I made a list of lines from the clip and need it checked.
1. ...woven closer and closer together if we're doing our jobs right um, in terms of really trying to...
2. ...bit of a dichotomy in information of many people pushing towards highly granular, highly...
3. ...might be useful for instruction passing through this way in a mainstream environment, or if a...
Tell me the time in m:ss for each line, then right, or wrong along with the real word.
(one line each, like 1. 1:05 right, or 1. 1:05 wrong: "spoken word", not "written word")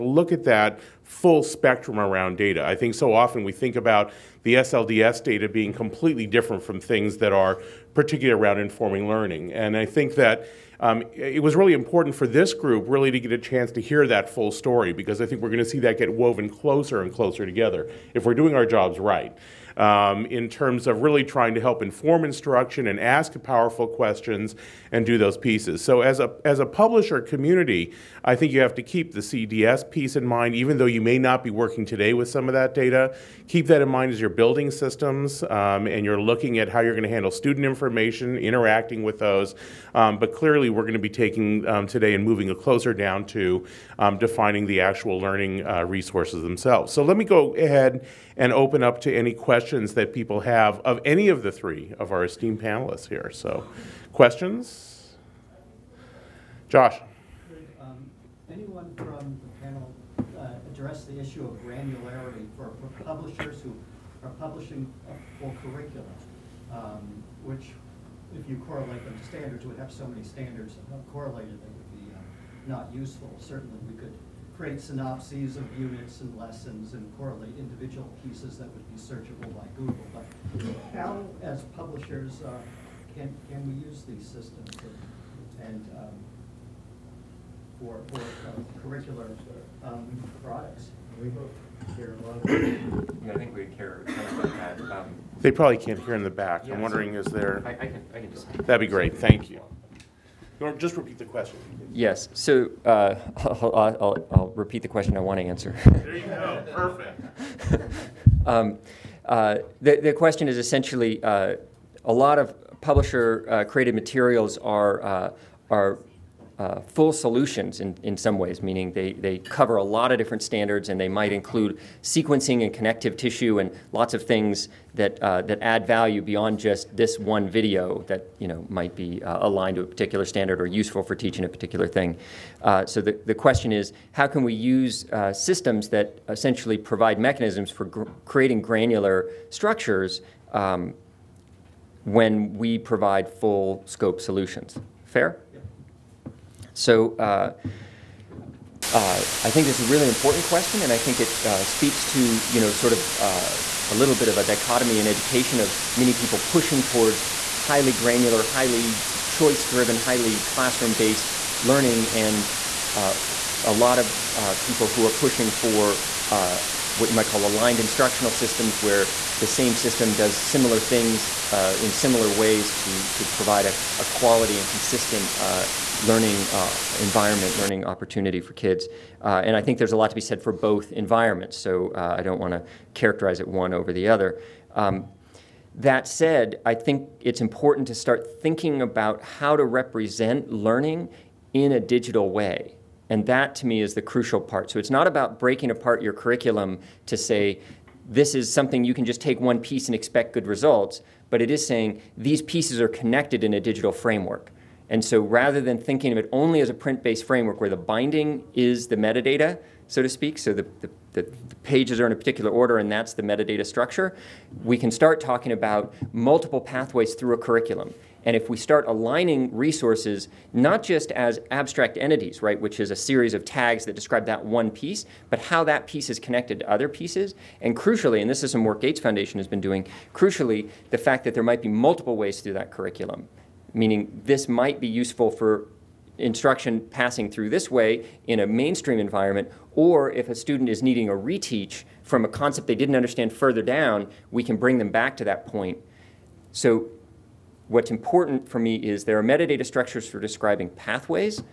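1. 0:16 right
2. 2:34 wrong: "education", not "information"
3. 3:54 right.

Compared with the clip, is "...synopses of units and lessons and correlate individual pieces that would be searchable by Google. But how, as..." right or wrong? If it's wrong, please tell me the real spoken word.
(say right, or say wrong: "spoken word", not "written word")
right.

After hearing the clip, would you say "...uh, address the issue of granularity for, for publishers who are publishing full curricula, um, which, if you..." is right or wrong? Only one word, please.
right.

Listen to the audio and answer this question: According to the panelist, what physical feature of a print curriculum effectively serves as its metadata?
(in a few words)
The binding.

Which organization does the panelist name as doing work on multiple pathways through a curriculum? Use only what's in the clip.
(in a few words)
Gates Foundation.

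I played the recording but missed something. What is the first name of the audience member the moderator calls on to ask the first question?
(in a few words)
Josh.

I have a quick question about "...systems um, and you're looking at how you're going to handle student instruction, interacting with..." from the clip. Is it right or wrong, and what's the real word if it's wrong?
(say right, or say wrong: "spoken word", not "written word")
wrong: "information", not "instruction".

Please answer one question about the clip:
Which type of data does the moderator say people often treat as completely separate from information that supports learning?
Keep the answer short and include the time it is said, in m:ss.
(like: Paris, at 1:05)
SLDS data, at 0:04.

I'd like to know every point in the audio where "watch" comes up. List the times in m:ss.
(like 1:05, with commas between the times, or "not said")
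not said.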